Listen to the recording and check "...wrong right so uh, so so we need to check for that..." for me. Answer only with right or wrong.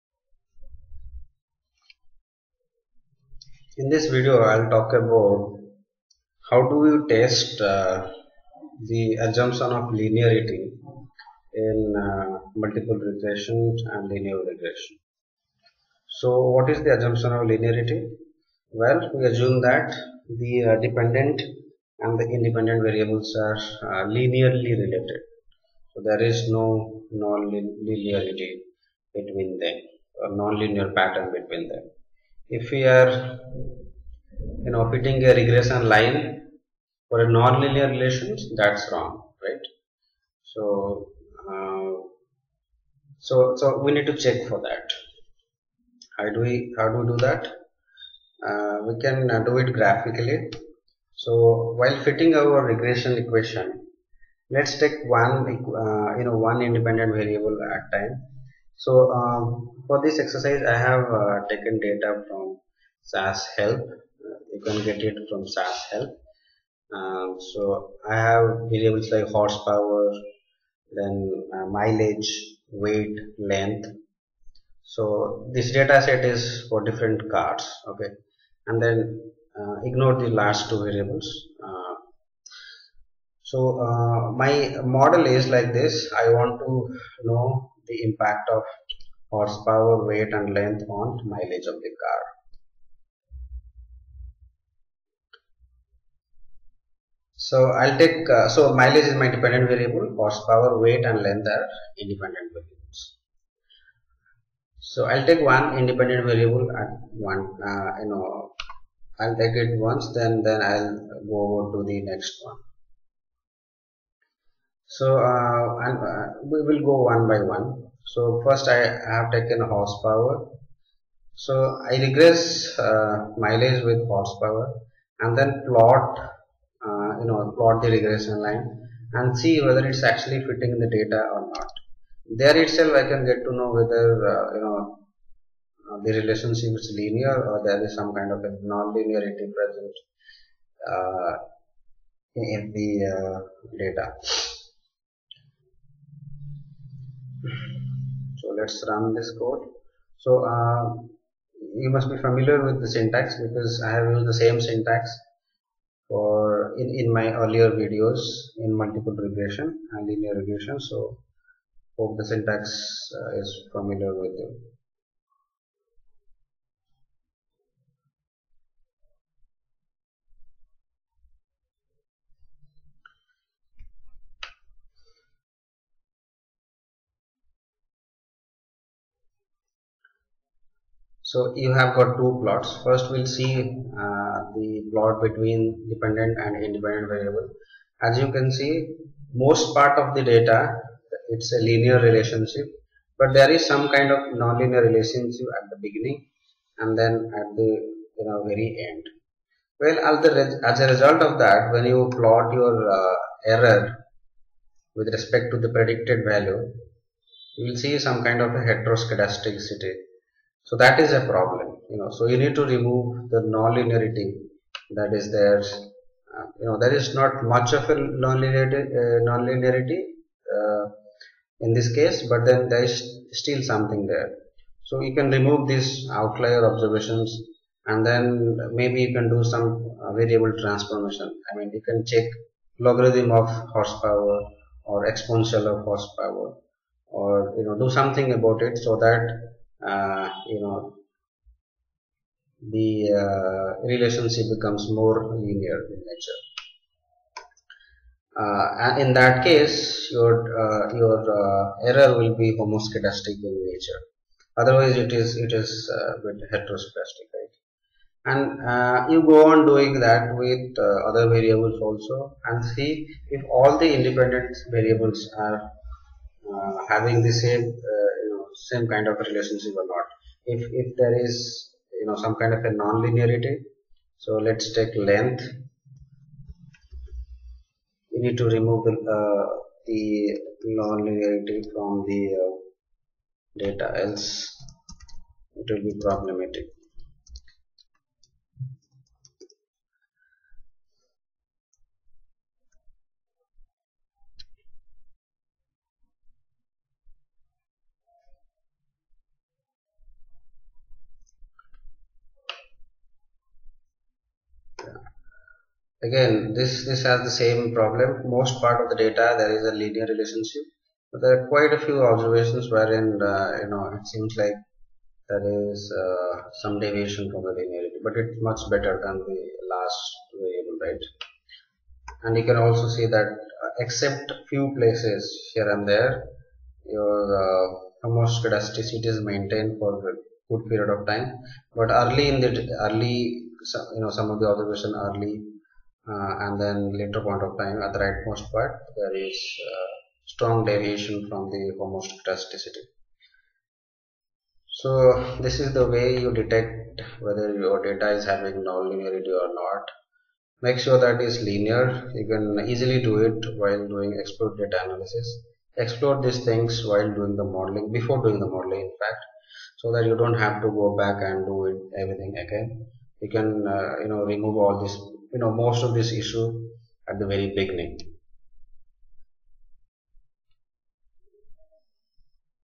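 right.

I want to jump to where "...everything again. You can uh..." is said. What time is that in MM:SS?
06:02.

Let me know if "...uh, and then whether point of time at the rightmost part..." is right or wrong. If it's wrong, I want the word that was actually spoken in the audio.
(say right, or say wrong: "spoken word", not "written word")
wrong: "later", not "whether".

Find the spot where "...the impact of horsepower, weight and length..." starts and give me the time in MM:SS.
01:27.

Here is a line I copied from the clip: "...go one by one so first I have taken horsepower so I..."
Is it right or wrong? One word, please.
right.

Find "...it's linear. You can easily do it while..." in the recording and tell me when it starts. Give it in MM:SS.
05:51.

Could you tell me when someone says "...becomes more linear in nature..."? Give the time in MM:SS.
04:04.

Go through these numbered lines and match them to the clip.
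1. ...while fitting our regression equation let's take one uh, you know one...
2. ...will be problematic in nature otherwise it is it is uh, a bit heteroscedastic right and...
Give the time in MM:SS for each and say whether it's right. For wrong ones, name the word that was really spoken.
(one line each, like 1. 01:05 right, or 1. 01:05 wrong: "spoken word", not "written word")
1. 00:51 right
2. 04:12 wrong: "homoscedastic", not "problematic".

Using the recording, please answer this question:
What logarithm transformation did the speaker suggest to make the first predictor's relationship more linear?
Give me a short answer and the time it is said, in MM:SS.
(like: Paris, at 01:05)
Logarithm of horsepower, at 03:52.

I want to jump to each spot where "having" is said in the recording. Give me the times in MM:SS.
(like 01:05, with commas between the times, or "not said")
04:26, 05:48.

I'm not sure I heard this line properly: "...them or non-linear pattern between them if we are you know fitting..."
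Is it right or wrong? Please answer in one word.
right.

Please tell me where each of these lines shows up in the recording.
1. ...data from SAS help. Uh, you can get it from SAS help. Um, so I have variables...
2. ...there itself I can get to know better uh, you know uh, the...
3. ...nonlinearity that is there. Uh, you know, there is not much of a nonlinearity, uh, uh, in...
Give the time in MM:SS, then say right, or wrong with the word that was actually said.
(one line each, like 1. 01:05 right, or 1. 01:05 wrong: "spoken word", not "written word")
1. 01:01 right
2. 02:12 wrong: "whether", not "better"
3. 03:33 right.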